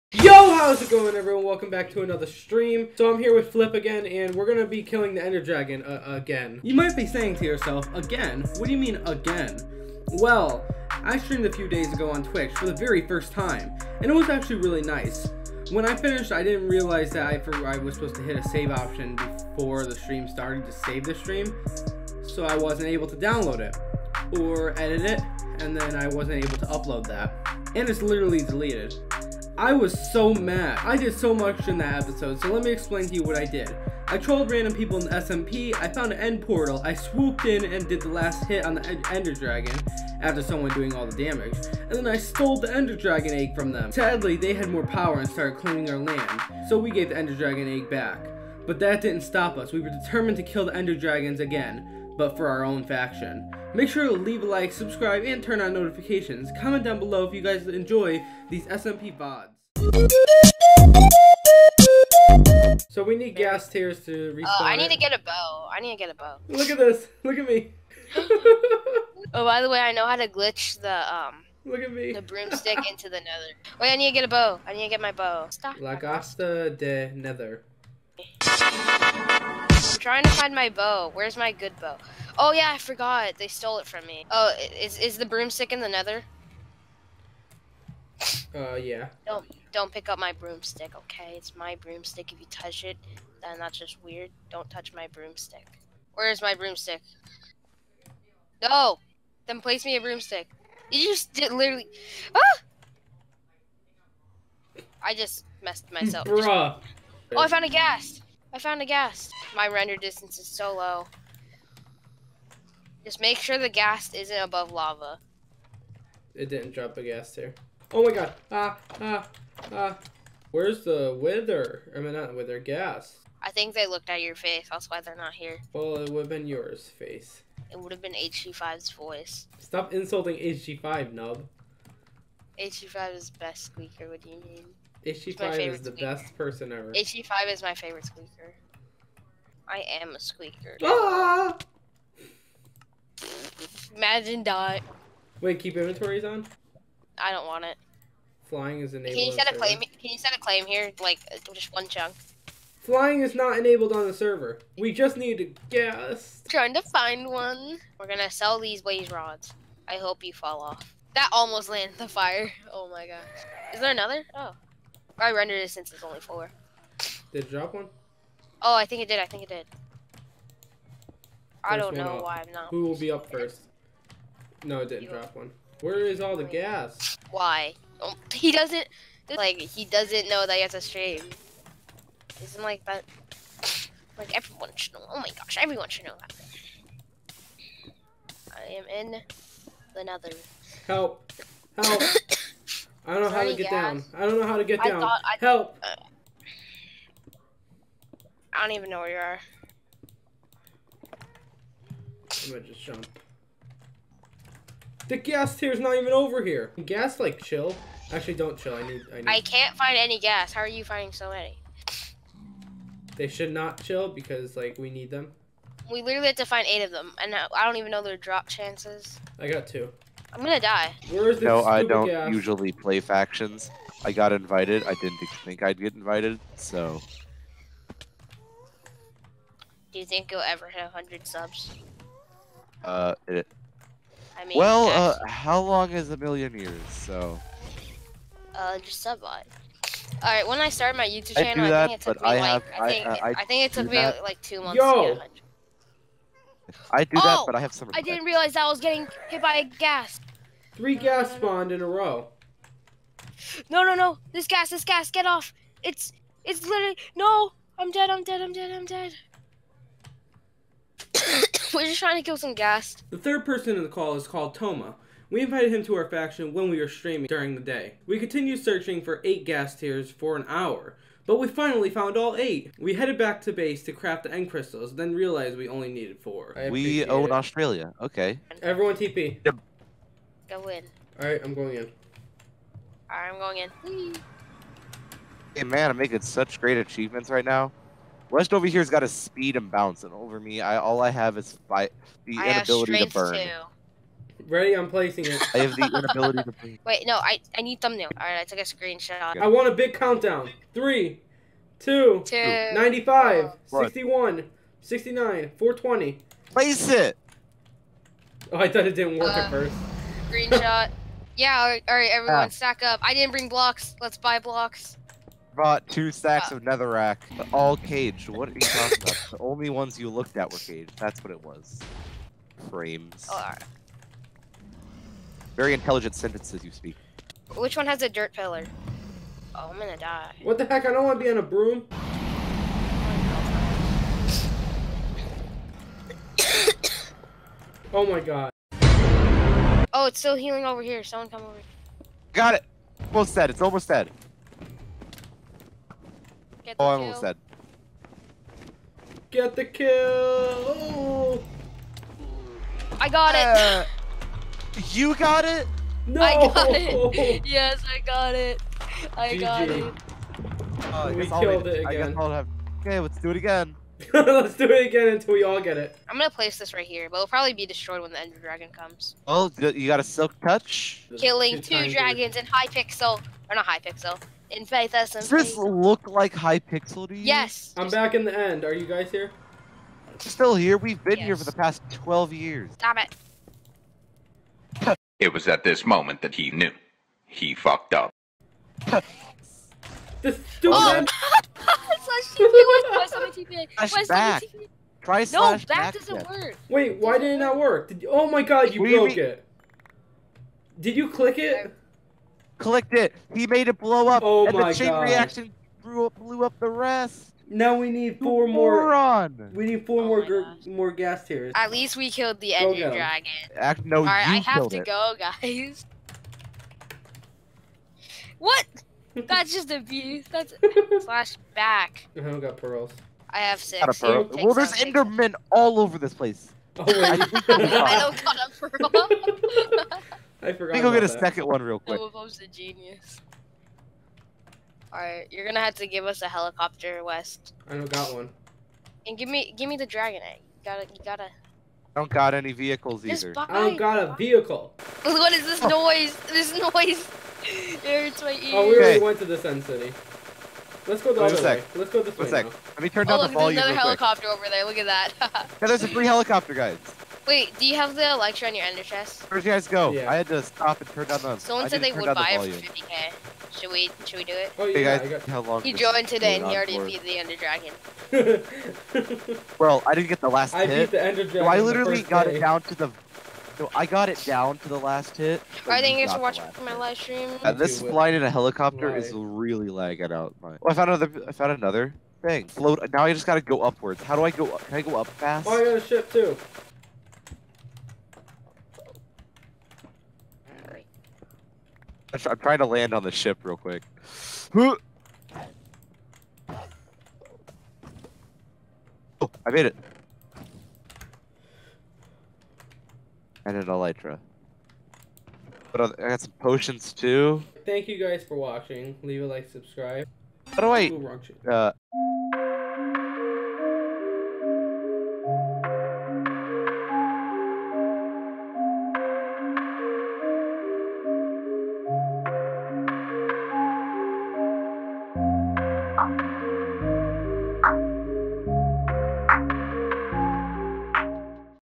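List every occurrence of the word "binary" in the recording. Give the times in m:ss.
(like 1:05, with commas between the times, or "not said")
not said.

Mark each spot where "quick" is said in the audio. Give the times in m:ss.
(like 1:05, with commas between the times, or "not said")
7:11, 7:34, 8:13.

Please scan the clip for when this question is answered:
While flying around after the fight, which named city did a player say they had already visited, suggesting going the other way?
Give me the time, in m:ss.
7:29.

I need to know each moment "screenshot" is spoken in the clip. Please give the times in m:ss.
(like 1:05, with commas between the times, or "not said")
4:58, 5:10.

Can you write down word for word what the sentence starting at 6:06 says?
I'm gonna place this right here, but it'll probably be destroyed when the Ender Dragon comes.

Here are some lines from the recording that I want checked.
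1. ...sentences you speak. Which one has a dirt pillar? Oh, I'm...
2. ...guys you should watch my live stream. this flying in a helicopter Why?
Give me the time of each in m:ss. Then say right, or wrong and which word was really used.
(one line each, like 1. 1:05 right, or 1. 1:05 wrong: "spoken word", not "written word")
1. 5:26 right
2. 7:55 right.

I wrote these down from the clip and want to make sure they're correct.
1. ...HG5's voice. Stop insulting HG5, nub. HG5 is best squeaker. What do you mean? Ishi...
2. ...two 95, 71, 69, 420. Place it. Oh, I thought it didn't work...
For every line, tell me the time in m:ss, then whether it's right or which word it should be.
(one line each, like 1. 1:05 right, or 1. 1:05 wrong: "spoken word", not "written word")
1. 2:08 right
2. 5:02 wrong: "61", not "71".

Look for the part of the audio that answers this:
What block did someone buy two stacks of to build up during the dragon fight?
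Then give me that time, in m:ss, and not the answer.
5:16.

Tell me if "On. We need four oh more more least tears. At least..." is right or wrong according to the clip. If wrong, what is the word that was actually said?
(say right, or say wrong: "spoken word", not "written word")
wrong: "ghast", not "least".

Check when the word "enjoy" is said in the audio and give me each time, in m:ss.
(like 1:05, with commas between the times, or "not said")
0:57.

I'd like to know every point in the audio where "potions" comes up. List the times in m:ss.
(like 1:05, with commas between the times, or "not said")
8:26.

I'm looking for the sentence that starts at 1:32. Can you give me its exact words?
If you touch it, then that's just weird.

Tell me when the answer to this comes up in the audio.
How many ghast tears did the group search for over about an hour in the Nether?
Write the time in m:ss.
4:29.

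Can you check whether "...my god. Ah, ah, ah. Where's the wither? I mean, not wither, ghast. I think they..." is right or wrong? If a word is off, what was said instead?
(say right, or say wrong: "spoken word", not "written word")
right.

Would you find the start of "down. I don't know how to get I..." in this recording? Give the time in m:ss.
3:13.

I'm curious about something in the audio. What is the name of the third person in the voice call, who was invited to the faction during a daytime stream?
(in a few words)
Toma.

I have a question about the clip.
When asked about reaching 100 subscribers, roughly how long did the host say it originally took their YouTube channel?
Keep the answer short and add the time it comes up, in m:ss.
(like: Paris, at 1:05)
2 months, at 4:04.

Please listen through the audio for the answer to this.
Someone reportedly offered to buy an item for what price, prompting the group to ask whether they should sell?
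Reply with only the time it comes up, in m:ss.
7:42.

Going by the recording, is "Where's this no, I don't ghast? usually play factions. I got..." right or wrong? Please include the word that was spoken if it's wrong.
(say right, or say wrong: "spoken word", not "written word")
right.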